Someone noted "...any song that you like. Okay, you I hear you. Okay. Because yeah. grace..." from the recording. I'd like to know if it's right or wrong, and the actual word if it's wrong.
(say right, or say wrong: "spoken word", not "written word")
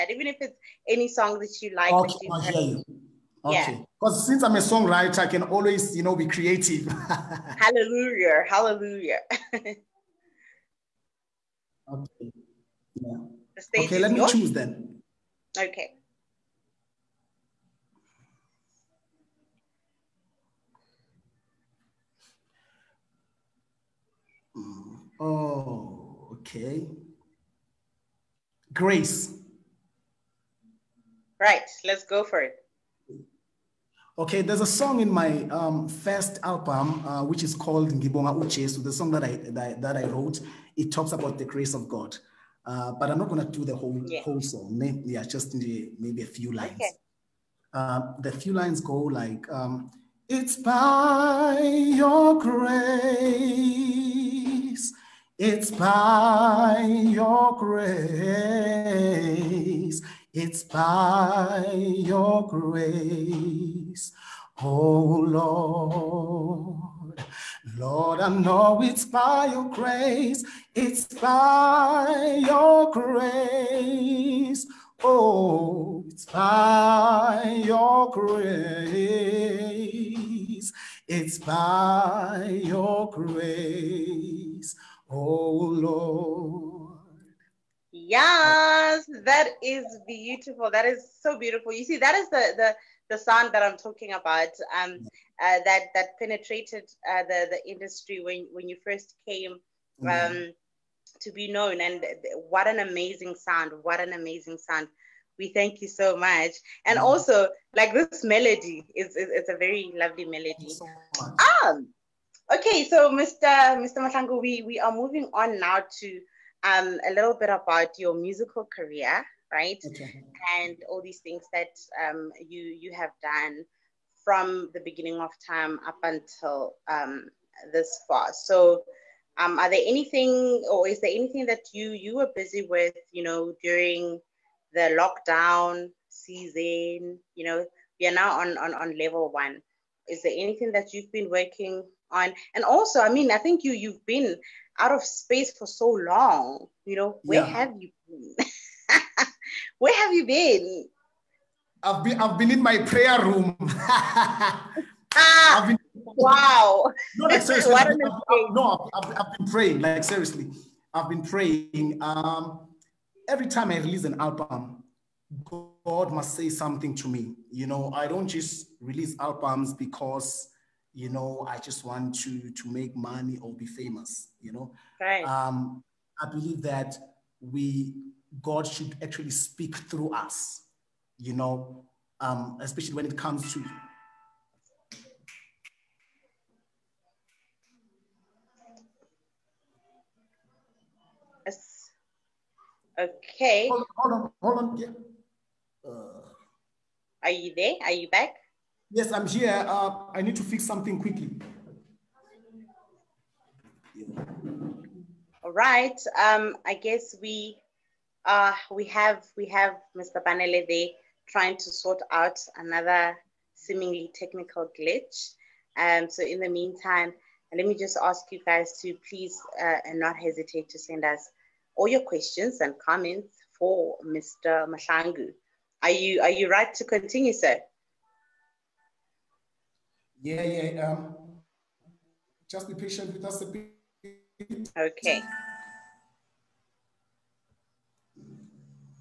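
wrong: "since", not "grace".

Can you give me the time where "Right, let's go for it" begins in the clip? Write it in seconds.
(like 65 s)
31 s.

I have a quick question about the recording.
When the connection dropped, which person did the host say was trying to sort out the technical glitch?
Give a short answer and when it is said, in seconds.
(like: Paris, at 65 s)
Mr. Banele, at 209 s.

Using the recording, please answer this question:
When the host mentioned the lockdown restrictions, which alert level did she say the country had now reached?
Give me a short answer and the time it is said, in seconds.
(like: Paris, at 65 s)
Level one, at 138 s.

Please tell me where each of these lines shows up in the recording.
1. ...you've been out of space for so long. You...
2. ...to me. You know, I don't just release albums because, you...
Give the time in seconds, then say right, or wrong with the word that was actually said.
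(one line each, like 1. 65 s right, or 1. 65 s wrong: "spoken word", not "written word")
1. 143 s right
2. 166 s right.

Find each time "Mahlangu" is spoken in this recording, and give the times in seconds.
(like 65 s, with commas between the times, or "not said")
114 s, 224 s.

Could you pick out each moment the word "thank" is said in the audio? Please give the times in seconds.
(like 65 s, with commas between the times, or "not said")
105 s.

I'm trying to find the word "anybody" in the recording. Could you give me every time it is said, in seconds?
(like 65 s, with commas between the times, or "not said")
not said.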